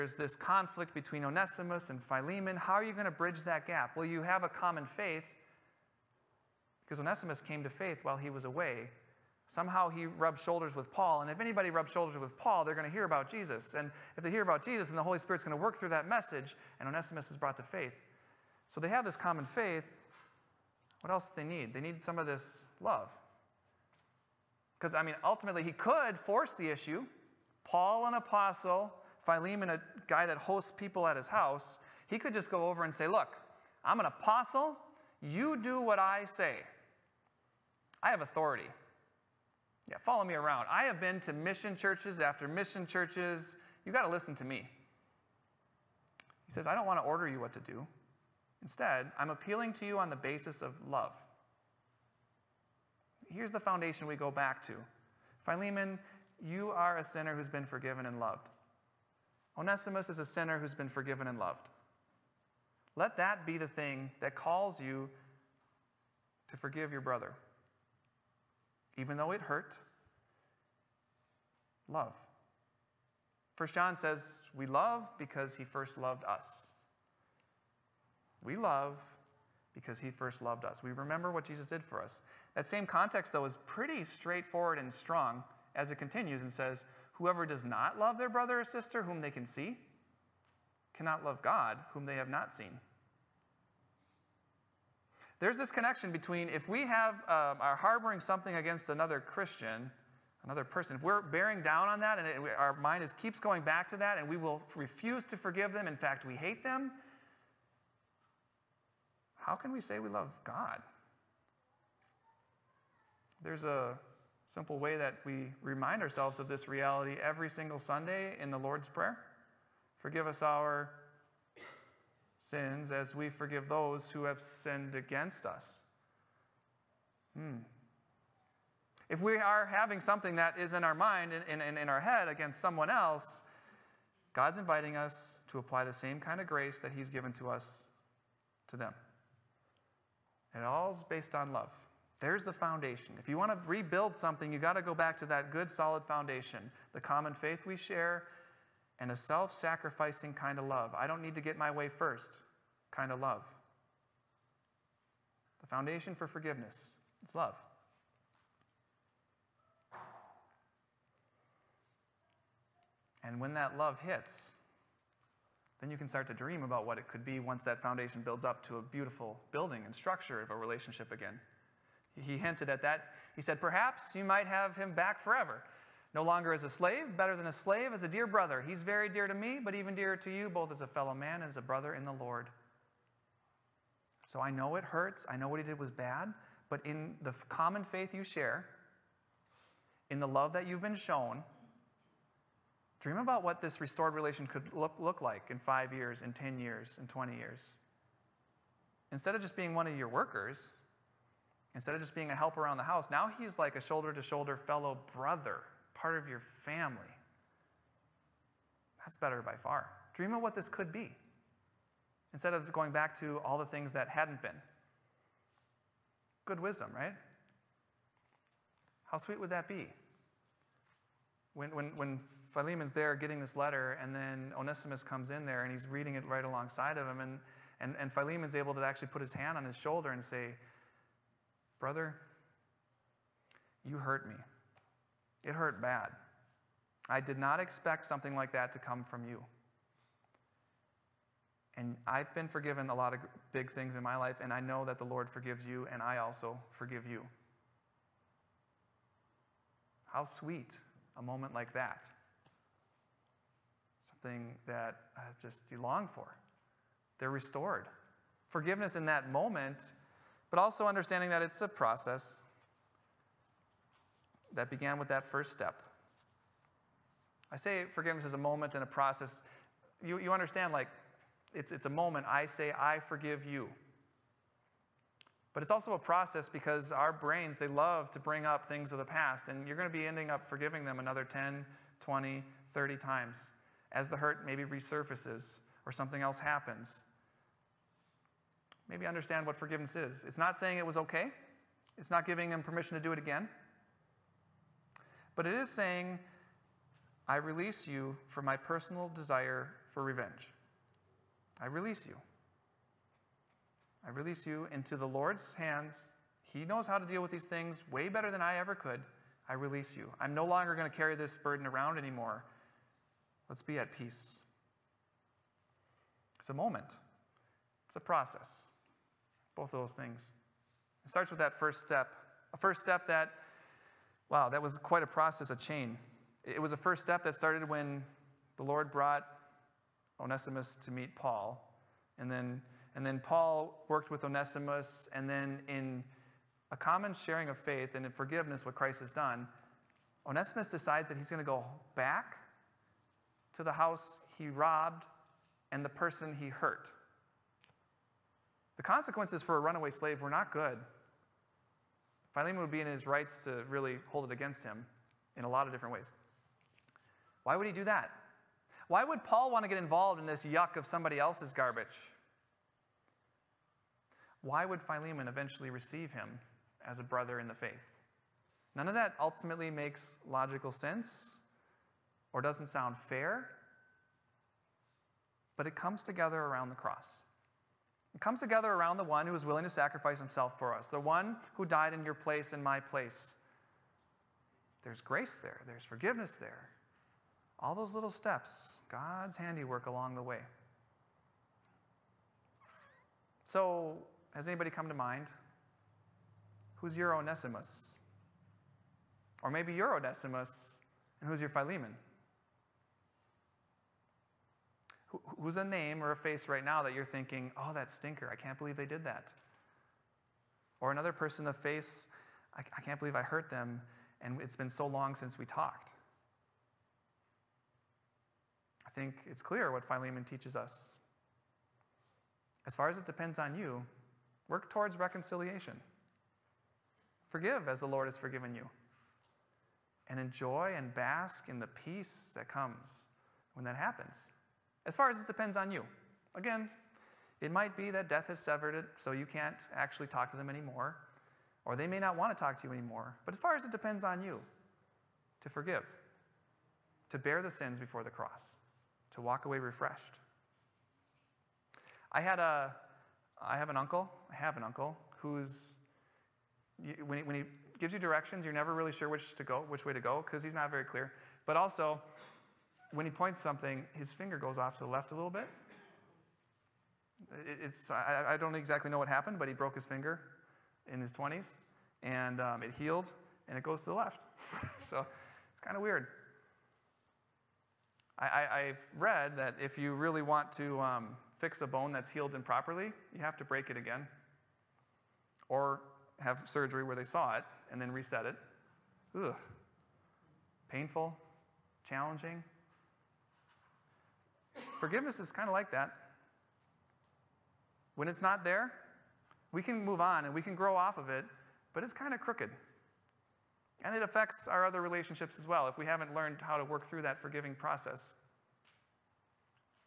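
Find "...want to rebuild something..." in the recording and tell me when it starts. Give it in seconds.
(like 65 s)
143 s.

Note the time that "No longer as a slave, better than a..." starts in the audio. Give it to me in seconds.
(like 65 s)
176 s.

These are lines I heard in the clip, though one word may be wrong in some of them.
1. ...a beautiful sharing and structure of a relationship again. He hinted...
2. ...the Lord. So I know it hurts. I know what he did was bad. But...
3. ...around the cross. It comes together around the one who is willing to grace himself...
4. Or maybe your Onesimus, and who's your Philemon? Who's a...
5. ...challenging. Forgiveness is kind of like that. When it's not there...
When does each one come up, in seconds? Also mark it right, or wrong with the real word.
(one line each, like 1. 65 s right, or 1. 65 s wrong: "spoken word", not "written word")
1. 168 s wrong: "building", not "sharing"
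2. 182 s right
3. 376 s wrong: "sacrifice", not "grace"
4. 399 s right
5. 491 s right.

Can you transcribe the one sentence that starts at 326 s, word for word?
It was a first step that started when the Lord brought Onesimus to meet Paul.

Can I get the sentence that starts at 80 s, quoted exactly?
We remember what Jesus did for us.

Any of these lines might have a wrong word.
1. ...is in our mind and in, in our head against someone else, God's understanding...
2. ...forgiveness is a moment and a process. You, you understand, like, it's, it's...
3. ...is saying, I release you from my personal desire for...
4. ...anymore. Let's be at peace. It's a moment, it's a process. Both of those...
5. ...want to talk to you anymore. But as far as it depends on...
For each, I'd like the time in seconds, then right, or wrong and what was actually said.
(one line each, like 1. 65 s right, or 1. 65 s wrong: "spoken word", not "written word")
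1. 130 s wrong: "inviting", not "understanding"
2. 267 s right
3. 295 s right
4. 311 s right
5. 442 s right.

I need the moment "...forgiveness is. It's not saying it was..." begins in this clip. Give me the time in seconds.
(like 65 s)
289 s.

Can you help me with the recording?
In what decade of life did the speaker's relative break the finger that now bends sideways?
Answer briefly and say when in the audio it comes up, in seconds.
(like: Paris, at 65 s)
His 20s, at 471 s.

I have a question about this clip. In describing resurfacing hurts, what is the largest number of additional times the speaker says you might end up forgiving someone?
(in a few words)
30.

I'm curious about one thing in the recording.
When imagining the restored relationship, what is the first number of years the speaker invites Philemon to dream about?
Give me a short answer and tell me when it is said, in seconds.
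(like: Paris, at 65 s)
5, at 195 s.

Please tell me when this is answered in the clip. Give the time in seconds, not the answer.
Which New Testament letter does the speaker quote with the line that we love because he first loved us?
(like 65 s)
73 s.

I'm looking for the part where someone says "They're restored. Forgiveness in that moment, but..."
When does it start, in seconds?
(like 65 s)
257 s.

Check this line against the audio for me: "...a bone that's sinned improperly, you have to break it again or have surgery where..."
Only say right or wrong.
wrong.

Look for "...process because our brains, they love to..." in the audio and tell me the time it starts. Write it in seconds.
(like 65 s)
275 s.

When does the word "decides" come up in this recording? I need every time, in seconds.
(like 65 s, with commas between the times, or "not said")
340 s.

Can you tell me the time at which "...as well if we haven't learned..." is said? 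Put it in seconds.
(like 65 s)
505 s.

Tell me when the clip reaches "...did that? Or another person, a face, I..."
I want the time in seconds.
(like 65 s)
408 s.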